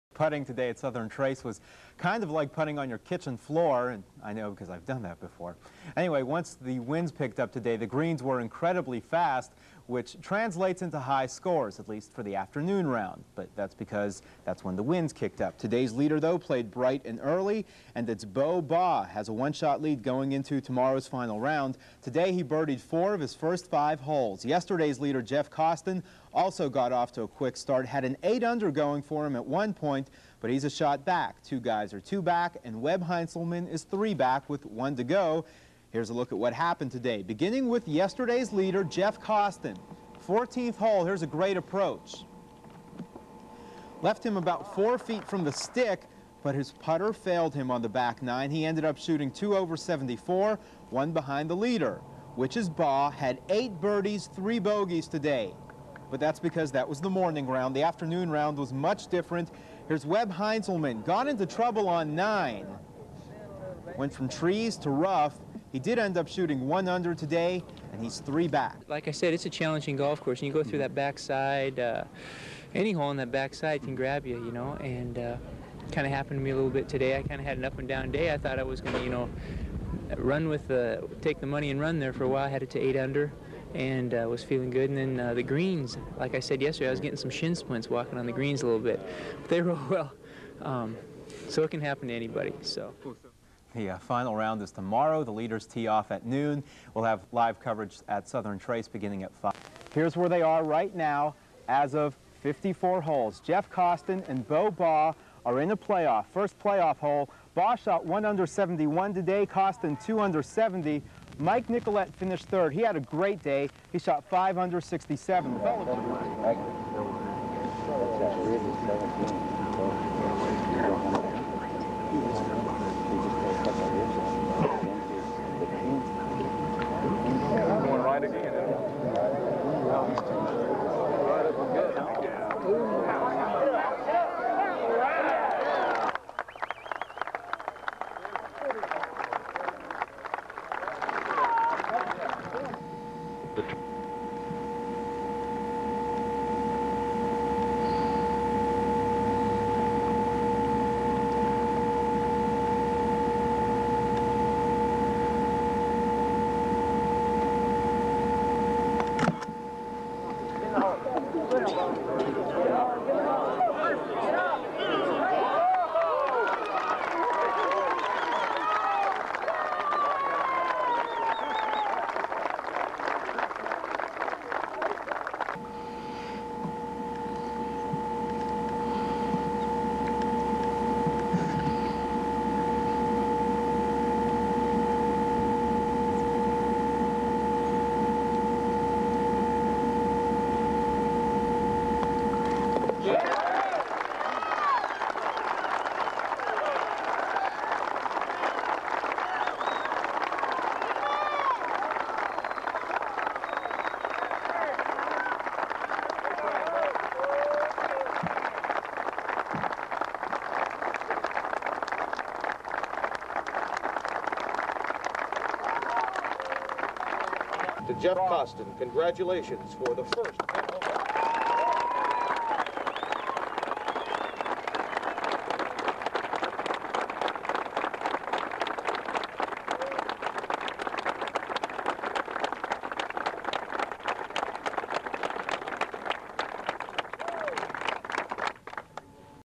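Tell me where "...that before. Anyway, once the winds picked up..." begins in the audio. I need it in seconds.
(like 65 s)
5 s.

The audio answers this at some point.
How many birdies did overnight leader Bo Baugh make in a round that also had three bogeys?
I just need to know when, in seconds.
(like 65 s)
53 s.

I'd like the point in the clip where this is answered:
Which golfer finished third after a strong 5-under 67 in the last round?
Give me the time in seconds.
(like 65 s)
111 s.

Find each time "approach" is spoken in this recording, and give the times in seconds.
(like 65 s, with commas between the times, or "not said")
41 s.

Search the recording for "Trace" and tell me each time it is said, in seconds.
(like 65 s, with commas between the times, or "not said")
1 s, 98 s.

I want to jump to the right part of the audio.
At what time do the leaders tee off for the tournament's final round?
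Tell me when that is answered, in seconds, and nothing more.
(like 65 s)
96 s.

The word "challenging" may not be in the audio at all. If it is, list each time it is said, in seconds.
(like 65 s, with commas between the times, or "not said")
69 s.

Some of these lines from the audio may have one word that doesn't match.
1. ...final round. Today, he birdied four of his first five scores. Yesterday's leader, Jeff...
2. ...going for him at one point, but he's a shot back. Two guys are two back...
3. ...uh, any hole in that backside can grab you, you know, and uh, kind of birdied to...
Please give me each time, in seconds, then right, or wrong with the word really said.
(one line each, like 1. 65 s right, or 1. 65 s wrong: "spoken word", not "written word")
1. 21 s wrong: "holes", not "scores"
2. 28 s right
3. 71 s wrong: "happened", not "birdied".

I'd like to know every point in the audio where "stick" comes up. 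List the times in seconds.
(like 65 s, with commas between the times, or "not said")
45 s.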